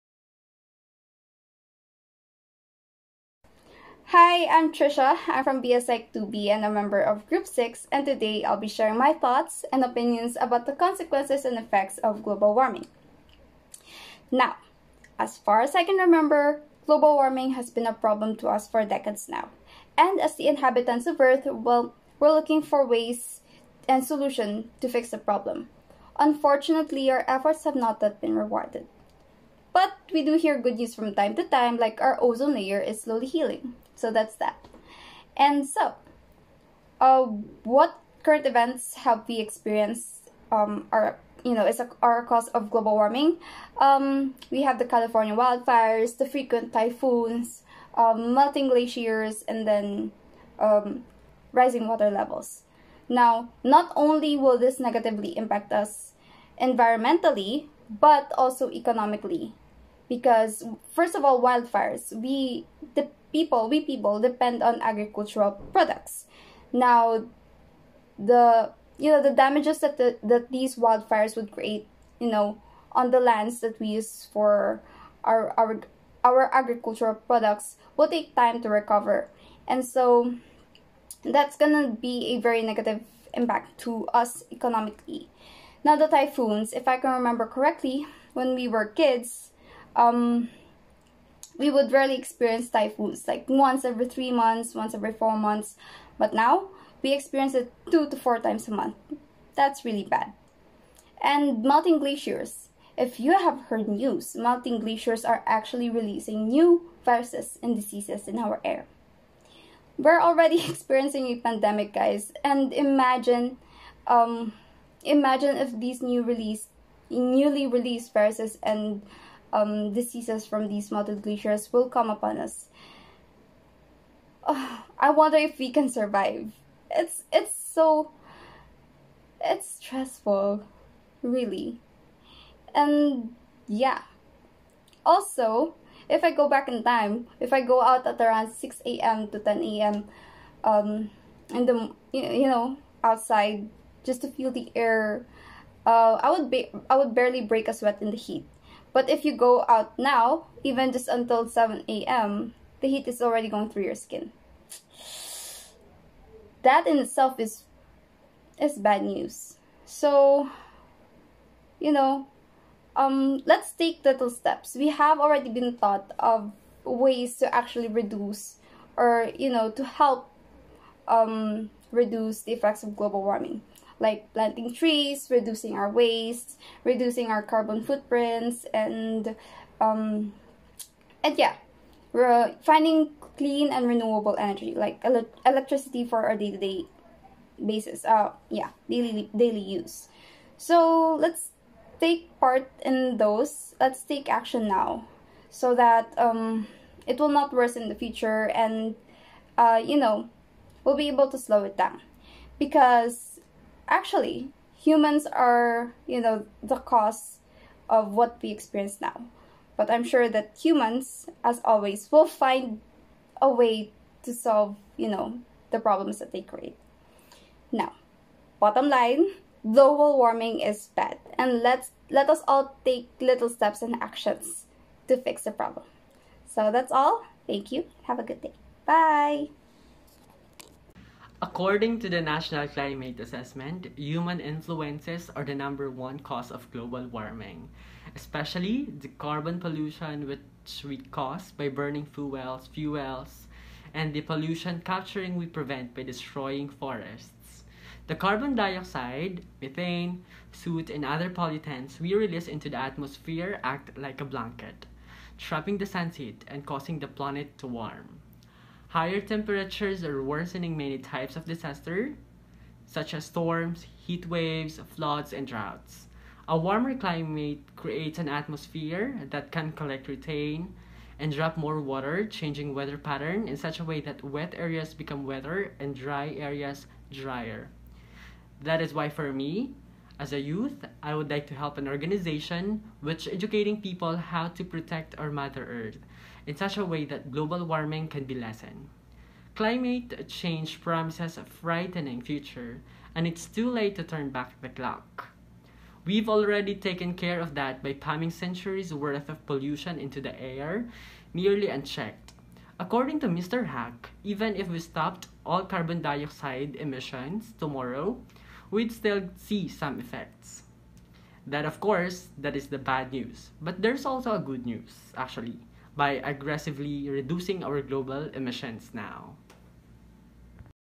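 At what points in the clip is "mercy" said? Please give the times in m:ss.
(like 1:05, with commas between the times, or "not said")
not said.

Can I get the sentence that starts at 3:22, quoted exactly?
Because actually, humans are, you know, the cause of what we experience now.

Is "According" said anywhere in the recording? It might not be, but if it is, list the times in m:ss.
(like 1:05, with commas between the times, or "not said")
3:51, 5:02.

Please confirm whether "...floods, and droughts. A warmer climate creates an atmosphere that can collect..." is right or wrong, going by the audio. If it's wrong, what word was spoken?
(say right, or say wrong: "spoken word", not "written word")
right.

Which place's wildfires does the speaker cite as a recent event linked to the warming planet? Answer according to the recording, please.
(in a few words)
California.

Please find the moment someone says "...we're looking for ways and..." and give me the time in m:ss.
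0:22.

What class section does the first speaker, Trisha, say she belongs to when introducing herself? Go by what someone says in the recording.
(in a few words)
BSEC 2B.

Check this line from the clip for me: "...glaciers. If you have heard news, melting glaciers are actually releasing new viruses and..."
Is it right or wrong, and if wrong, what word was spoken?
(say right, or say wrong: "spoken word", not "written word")
right.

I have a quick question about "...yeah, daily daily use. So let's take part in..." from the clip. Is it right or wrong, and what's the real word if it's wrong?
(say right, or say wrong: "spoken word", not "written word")
right.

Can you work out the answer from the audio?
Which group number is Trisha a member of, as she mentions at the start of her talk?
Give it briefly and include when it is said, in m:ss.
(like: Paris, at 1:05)
6, at 0:07.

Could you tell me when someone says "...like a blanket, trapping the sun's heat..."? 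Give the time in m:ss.
4:13.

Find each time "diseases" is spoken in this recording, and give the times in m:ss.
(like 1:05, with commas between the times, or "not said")
1:47, 1:59.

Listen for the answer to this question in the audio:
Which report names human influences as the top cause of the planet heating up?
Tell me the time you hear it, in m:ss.
3:52.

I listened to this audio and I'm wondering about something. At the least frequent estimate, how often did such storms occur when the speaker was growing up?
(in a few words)
once every four months.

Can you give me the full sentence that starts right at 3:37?
Now, bottom line, global warming is bad and let's let us all take little steps and actions to fix the problem.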